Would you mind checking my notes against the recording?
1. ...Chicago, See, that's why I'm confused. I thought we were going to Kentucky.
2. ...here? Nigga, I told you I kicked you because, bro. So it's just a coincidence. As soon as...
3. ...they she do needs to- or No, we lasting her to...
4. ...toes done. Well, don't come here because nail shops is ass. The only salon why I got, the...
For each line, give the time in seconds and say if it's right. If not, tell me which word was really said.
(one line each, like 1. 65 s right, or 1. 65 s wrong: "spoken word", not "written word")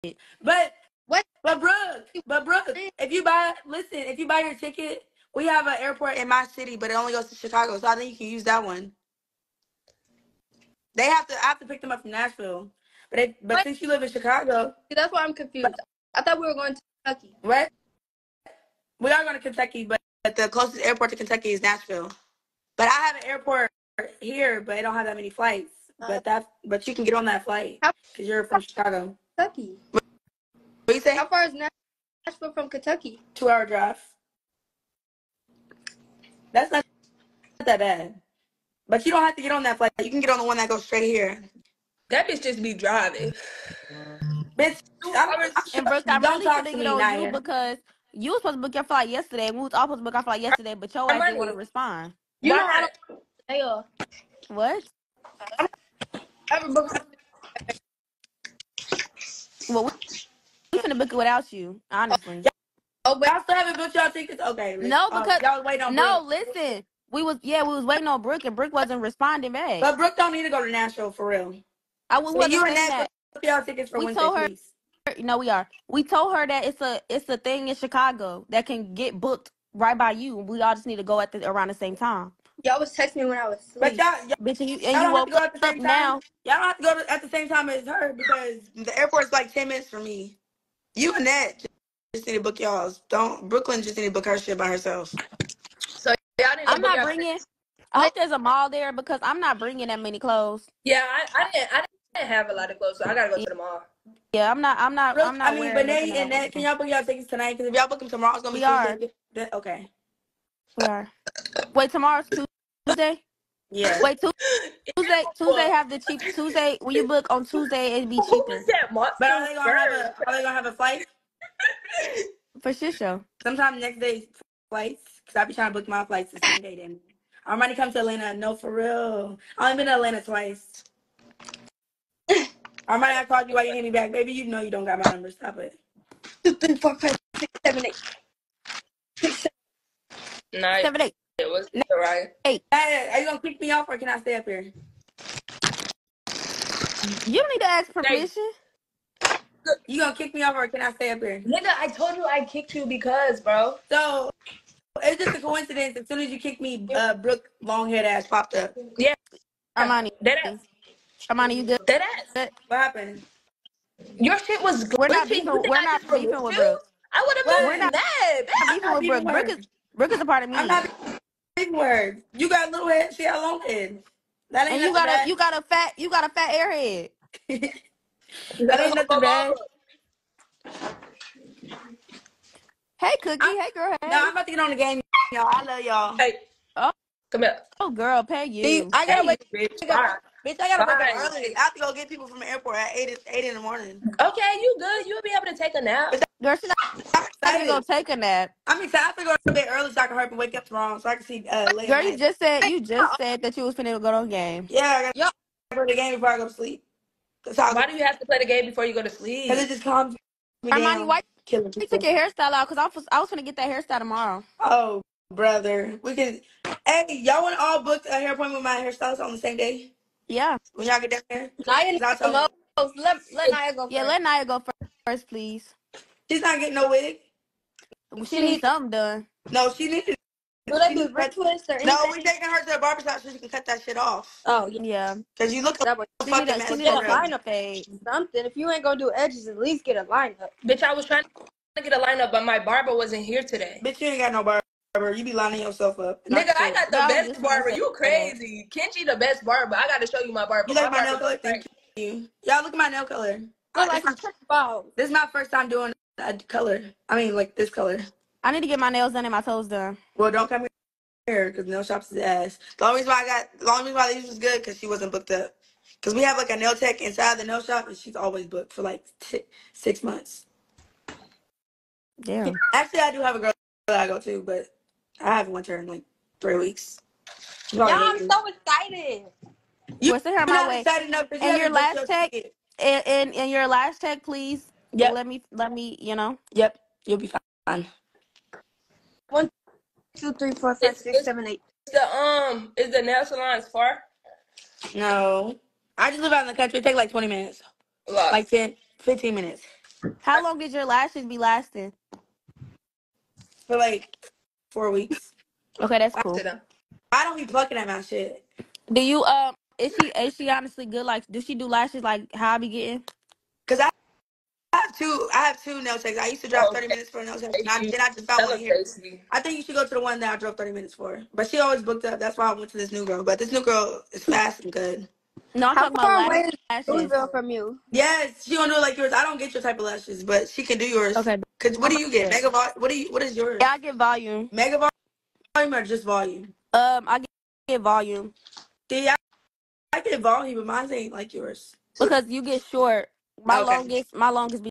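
1. 14 s right
2. 151 s right
3. 230 s wrong: "taking", not "lasting"
4. 259 s wrong: "reason", not "salon".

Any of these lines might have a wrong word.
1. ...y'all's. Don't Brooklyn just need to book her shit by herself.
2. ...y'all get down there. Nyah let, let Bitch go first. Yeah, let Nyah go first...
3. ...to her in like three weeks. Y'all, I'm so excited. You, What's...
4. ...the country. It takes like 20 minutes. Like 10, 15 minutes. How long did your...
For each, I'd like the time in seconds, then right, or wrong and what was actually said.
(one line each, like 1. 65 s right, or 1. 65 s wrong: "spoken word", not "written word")
1. 92 s right
2. 220 s wrong: "Nyah", not "Bitch"
3. 275 s right
4. 296 s right.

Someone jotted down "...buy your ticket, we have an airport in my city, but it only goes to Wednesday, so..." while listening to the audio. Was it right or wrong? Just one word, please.
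wrong.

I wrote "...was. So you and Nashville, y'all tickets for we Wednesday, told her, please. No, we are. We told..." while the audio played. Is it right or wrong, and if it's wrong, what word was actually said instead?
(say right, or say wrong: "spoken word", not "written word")
right.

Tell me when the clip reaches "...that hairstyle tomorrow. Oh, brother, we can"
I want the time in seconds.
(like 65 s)
213 s.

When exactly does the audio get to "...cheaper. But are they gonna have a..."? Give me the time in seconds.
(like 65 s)
118 s.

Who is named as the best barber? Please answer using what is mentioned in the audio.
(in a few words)
Kenji.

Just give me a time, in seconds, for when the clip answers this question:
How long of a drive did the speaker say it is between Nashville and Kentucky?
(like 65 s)
33 s.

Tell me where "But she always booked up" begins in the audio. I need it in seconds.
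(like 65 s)
321 s.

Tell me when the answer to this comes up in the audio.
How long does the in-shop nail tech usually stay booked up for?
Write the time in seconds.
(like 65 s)
269 s.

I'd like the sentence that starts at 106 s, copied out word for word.
Can y'all book y'all tickets tonight?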